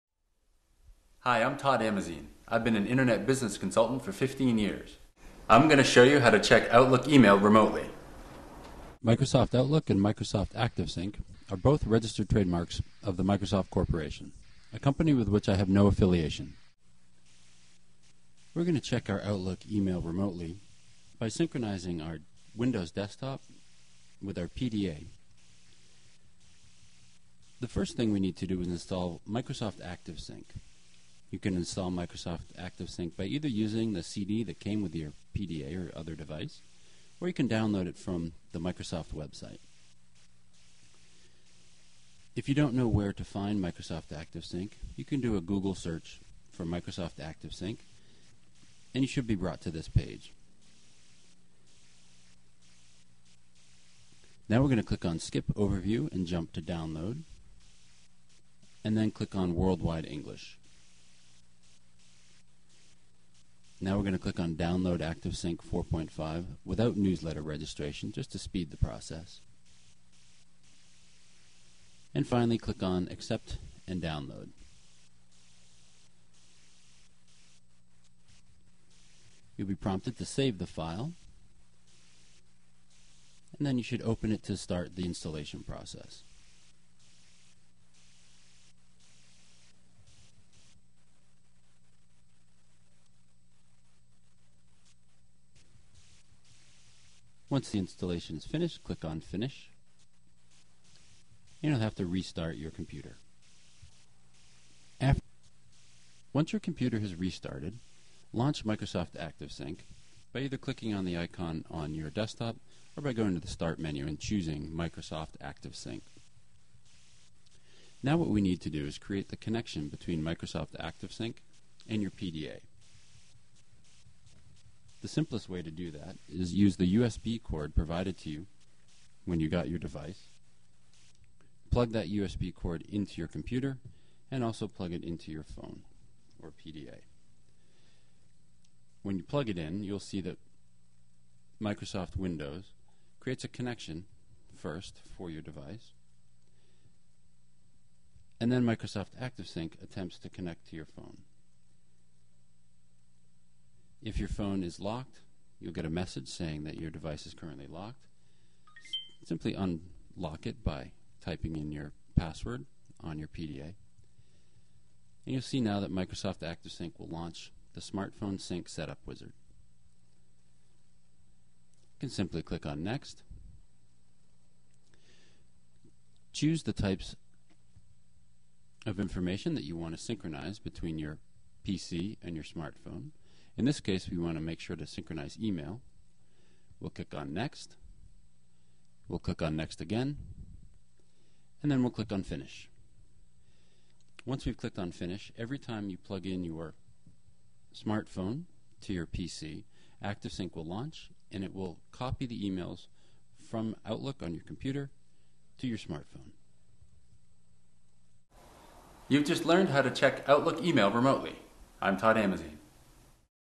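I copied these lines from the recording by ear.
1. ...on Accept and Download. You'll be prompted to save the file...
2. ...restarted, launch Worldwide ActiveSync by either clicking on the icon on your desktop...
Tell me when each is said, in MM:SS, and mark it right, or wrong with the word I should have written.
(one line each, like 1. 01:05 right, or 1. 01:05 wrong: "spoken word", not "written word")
1. 01:12 right
2. 01:47 wrong: "Microsoft", not "Worldwide".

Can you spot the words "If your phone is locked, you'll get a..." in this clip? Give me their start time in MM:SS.
02:34.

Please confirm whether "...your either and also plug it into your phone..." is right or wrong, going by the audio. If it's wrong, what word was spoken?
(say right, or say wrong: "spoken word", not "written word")
wrong: "computer", not "either".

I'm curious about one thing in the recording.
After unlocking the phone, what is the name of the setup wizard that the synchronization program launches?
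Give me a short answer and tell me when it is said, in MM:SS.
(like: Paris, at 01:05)
Smartphone Sync Setup Wizard, at 02:47.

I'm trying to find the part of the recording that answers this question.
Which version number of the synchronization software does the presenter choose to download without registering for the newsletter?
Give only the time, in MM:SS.
01:05.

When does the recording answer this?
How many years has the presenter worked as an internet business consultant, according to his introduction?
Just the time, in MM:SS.
00:04.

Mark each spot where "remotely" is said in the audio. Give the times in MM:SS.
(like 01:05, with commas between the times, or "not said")
00:07, 00:20, 03:30.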